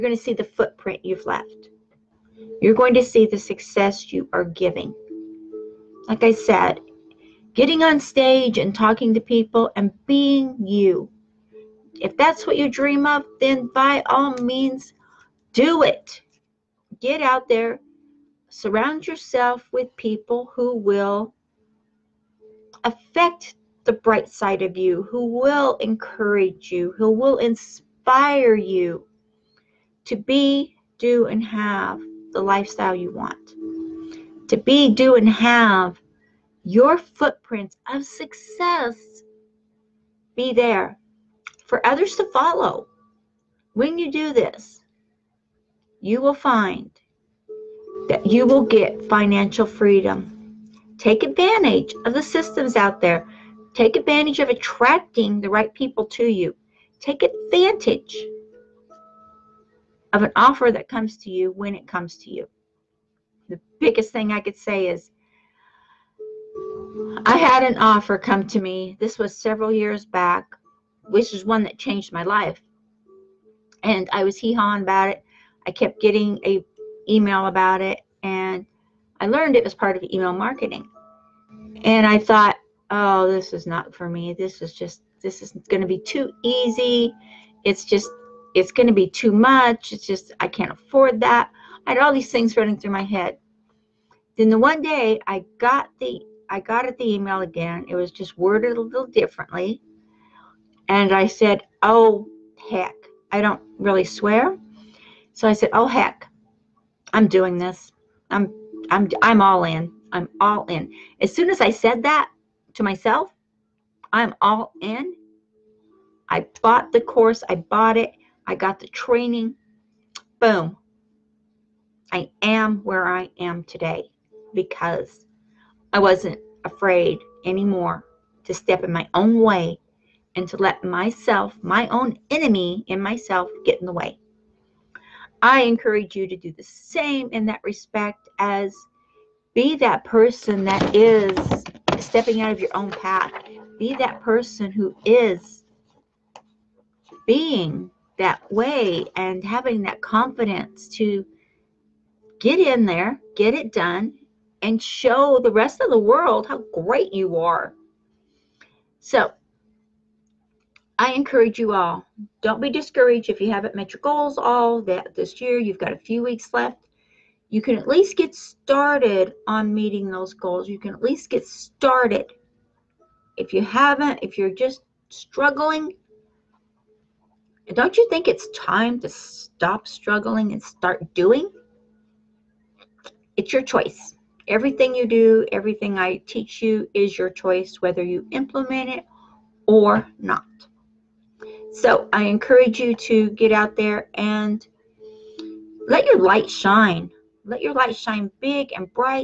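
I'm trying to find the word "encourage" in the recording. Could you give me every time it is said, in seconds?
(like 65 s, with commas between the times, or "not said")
25 s, 135 s, 161 s, 192 s.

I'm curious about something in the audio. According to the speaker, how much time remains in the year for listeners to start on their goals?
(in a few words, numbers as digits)
a few weeks.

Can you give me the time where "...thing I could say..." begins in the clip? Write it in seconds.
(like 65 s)
64 s.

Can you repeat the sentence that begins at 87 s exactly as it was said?
It's just it's going to be too much.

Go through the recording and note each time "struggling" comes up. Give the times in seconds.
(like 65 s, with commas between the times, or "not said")
175 s, 179 s.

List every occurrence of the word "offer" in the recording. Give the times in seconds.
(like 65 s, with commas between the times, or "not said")
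60 s, 67 s.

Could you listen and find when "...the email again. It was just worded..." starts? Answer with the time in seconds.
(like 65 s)
96 s.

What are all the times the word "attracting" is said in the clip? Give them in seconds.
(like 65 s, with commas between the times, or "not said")
54 s.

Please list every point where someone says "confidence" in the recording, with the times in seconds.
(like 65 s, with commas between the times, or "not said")
150 s.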